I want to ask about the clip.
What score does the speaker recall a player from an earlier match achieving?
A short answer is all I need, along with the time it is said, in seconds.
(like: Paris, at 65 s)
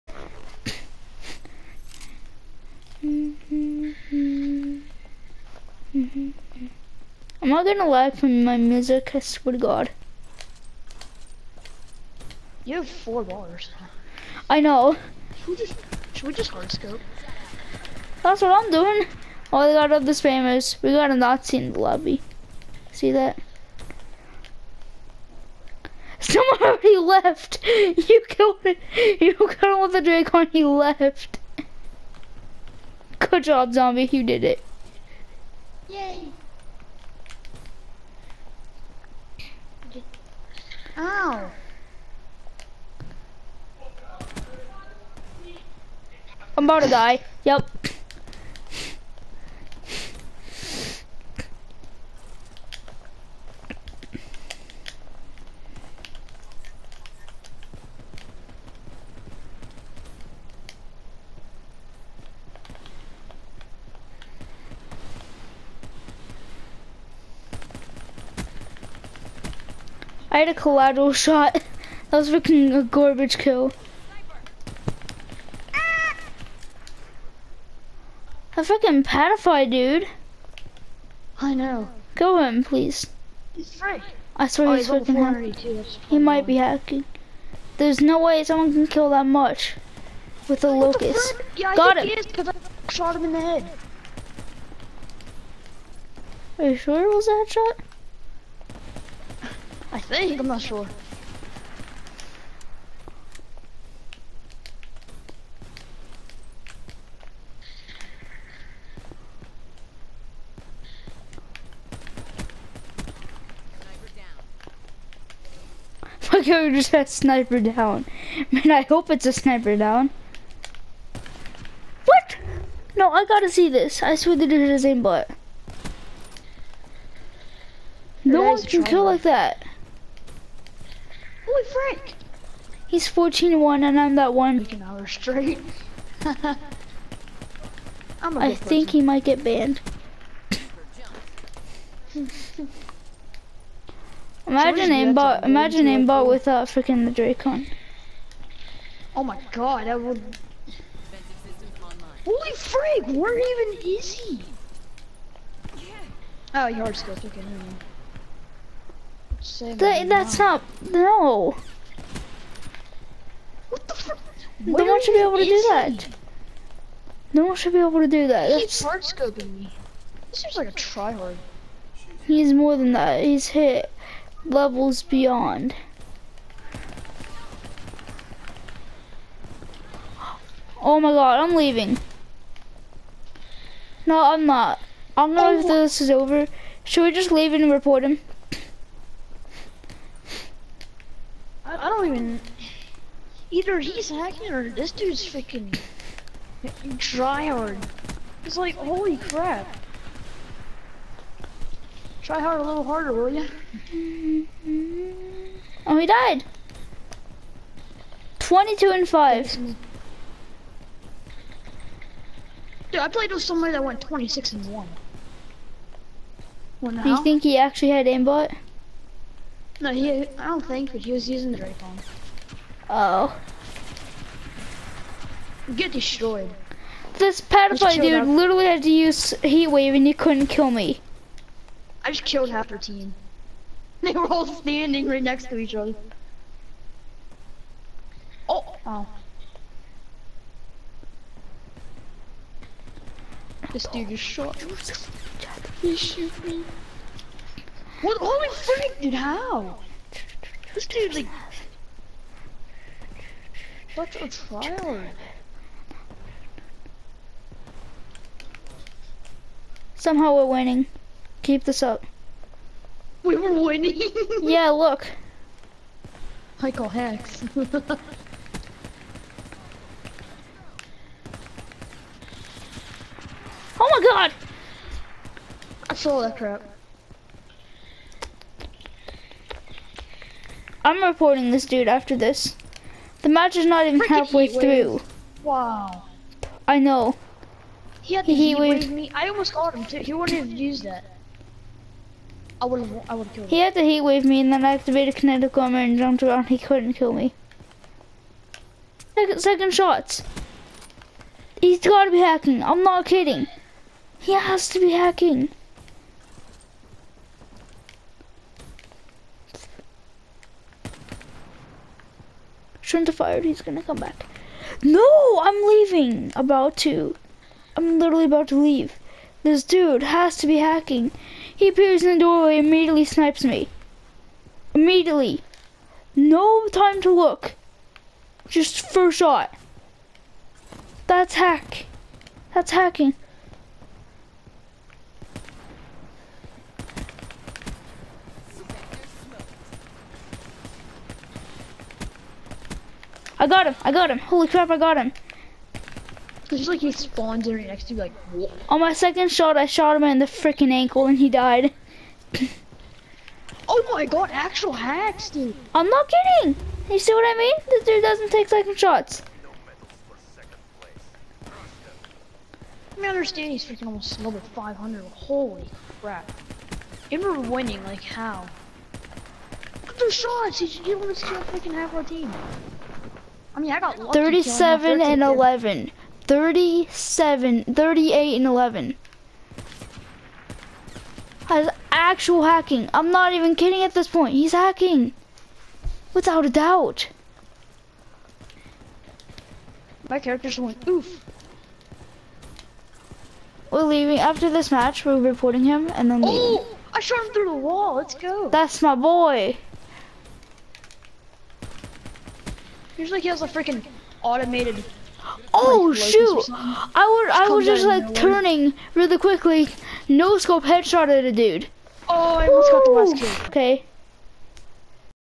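26 and 1, at 214 s.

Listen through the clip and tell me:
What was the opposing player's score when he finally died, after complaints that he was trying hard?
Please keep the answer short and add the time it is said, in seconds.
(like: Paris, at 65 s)
22 and 5, at 208 s.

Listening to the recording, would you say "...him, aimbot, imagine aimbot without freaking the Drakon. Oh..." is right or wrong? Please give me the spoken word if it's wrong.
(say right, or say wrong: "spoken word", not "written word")
right.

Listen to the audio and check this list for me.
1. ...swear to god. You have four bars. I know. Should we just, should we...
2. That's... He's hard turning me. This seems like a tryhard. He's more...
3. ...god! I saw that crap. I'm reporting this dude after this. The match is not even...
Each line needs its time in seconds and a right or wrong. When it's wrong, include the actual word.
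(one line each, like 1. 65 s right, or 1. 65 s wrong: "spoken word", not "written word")
1. 9 s right
2. 168 s wrong: "scoping", not "turning"
3. 274 s right.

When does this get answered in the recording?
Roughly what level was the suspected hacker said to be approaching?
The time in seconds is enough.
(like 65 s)
364 s.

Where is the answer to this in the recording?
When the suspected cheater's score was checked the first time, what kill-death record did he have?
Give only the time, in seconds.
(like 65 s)
133 s.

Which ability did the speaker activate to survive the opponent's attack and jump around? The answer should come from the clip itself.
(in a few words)
kinetic armor.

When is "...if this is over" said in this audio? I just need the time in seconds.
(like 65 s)
185 s.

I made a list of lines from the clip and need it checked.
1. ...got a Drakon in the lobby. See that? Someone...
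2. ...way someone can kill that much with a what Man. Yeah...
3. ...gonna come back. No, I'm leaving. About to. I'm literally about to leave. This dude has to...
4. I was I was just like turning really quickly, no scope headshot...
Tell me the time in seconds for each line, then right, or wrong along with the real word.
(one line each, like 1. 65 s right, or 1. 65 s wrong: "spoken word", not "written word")
1. 20 s wrong: "Nazi", not "Drakon"
2. 88 s wrong: "Locus", not "Man"
3. 313 s right
4. 406 s right.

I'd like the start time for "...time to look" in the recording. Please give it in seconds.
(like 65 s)
326 s.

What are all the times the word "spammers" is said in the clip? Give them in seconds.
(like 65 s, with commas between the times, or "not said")
20 s.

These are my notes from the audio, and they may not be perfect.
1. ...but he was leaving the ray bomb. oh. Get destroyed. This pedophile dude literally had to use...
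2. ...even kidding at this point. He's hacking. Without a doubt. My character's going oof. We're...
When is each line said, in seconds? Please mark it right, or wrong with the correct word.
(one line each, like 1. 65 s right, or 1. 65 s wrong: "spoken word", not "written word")
1. 220 s wrong: "using", not "leaving"
2. 383 s right.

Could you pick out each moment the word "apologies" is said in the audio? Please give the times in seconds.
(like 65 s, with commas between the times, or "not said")
not said.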